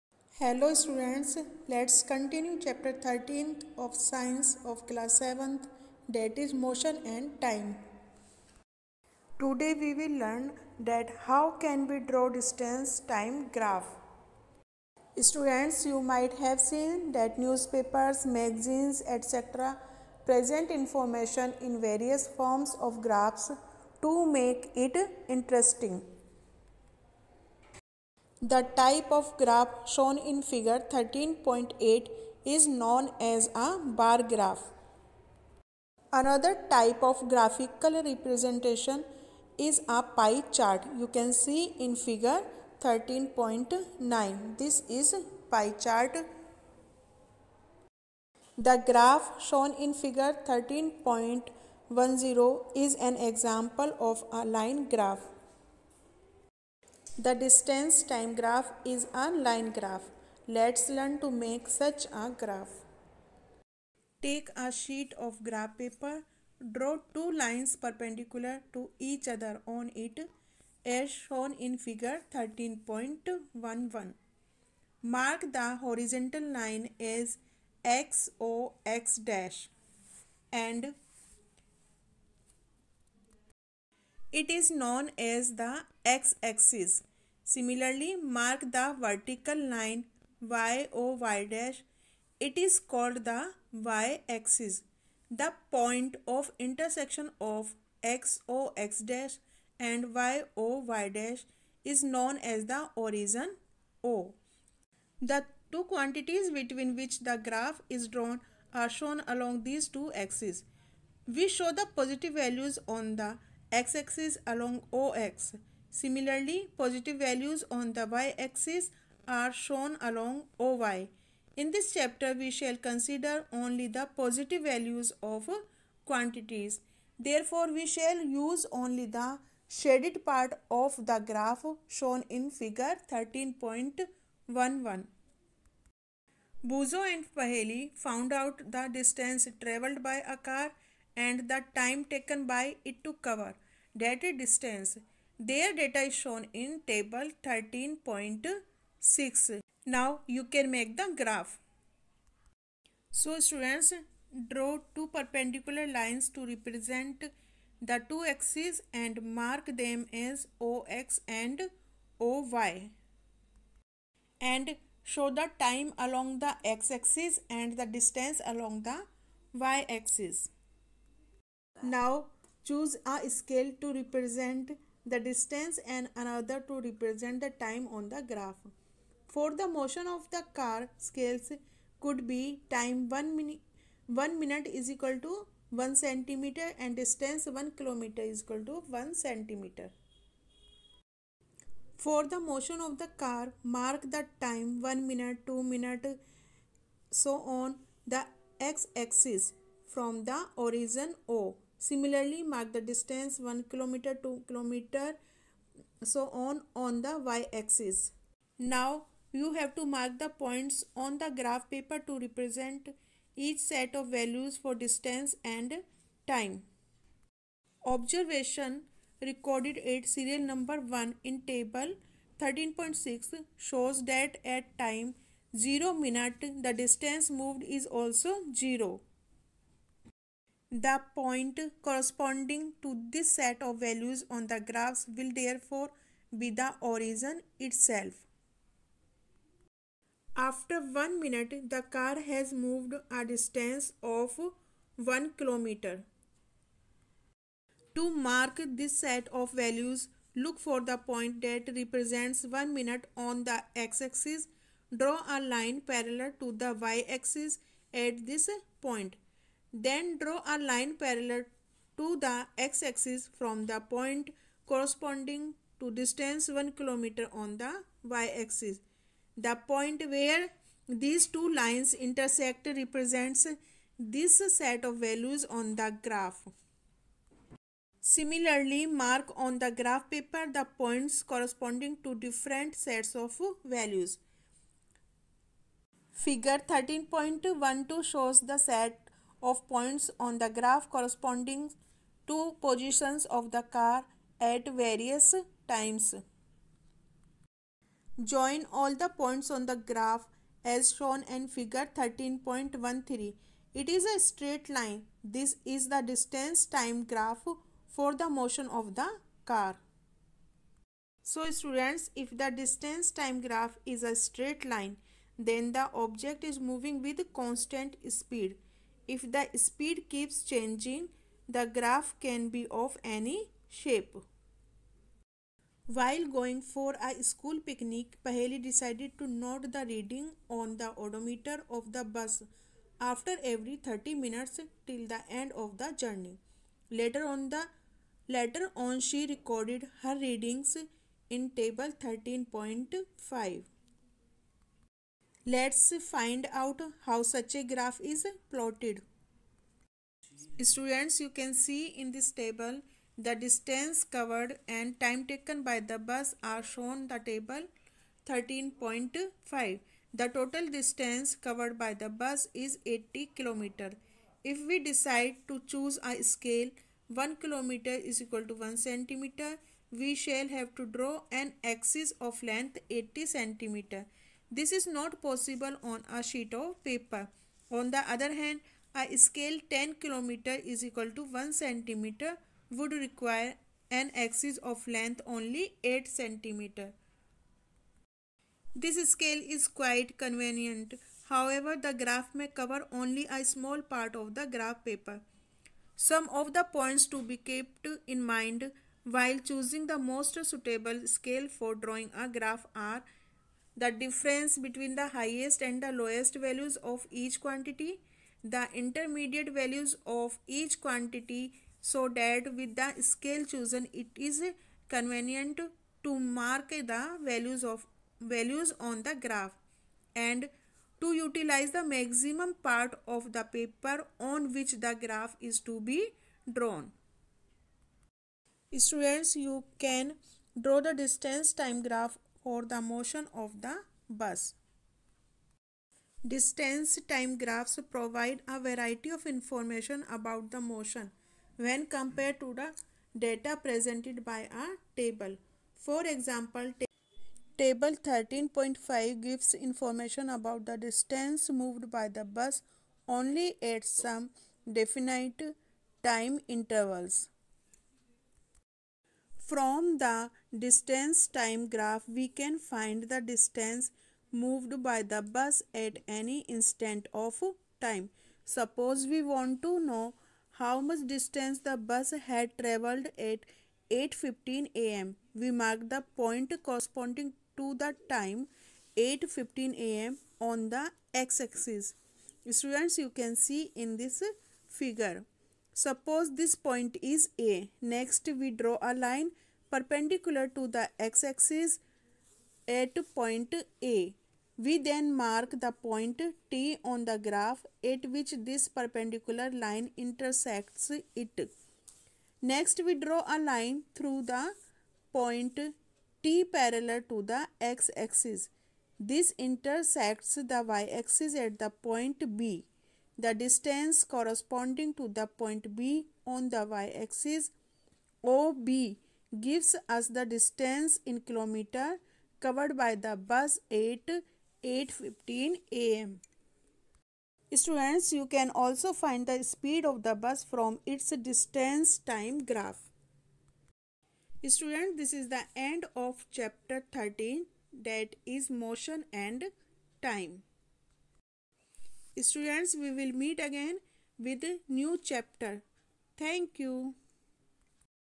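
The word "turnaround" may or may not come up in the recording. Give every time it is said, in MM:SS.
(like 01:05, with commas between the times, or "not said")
not said.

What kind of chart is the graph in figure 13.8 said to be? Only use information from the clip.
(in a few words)
Bar graph.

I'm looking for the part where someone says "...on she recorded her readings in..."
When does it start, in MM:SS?
05:38.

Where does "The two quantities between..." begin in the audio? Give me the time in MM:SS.
01:45.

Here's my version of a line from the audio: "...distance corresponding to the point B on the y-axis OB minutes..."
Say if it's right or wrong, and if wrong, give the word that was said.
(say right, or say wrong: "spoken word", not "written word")
wrong: "gives", not "minutes".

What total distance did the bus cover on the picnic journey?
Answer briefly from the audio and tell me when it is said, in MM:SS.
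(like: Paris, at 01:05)
80 km, at 06:02.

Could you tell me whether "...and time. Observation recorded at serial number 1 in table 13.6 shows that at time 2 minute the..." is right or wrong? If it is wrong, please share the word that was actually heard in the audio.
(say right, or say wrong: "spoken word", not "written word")
wrong: "0", not "2".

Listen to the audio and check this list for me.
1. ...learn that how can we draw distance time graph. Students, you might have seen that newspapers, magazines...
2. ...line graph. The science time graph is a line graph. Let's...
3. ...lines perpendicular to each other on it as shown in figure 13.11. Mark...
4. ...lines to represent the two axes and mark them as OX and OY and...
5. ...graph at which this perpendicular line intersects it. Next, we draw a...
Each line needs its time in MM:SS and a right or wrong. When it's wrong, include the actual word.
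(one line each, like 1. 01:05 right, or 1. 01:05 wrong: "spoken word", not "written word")
1. 00:10 right
2. 00:54 wrong: "distance", not "science"
3. 01:07 right
4. 02:35 right
5. 08:17 right.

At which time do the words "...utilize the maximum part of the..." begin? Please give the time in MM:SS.
07:01.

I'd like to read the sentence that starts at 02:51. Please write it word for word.
Now choose a scale to represent the distance and another to represent the time on the graph.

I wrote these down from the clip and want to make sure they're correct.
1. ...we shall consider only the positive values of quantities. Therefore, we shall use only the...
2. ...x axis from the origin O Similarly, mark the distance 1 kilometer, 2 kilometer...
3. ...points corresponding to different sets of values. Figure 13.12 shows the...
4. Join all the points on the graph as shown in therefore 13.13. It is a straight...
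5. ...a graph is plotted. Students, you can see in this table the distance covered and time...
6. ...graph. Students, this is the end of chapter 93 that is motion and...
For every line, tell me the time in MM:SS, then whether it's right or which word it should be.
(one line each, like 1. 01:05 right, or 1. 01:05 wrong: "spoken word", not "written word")
1. 02:02 right
2. 03:18 right
3. 04:40 right
4. 04:58 wrong: "figure", not "therefore"
5. 05:47 right
6. 08:52 wrong: "13", not "93".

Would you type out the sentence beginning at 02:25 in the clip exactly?
Their data is shown in table 13.6.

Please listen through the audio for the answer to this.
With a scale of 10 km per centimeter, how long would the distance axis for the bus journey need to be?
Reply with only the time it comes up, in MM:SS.
06:25.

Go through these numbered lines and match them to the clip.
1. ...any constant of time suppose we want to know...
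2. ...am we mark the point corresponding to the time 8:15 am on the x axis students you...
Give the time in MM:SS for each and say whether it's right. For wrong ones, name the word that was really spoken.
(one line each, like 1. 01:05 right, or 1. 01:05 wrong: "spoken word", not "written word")
1. 07:46 wrong: "instant", not "constant"
2. 07:54 right.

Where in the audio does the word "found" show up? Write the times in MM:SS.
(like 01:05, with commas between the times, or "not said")
02:17.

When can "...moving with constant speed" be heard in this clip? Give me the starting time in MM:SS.
05:16.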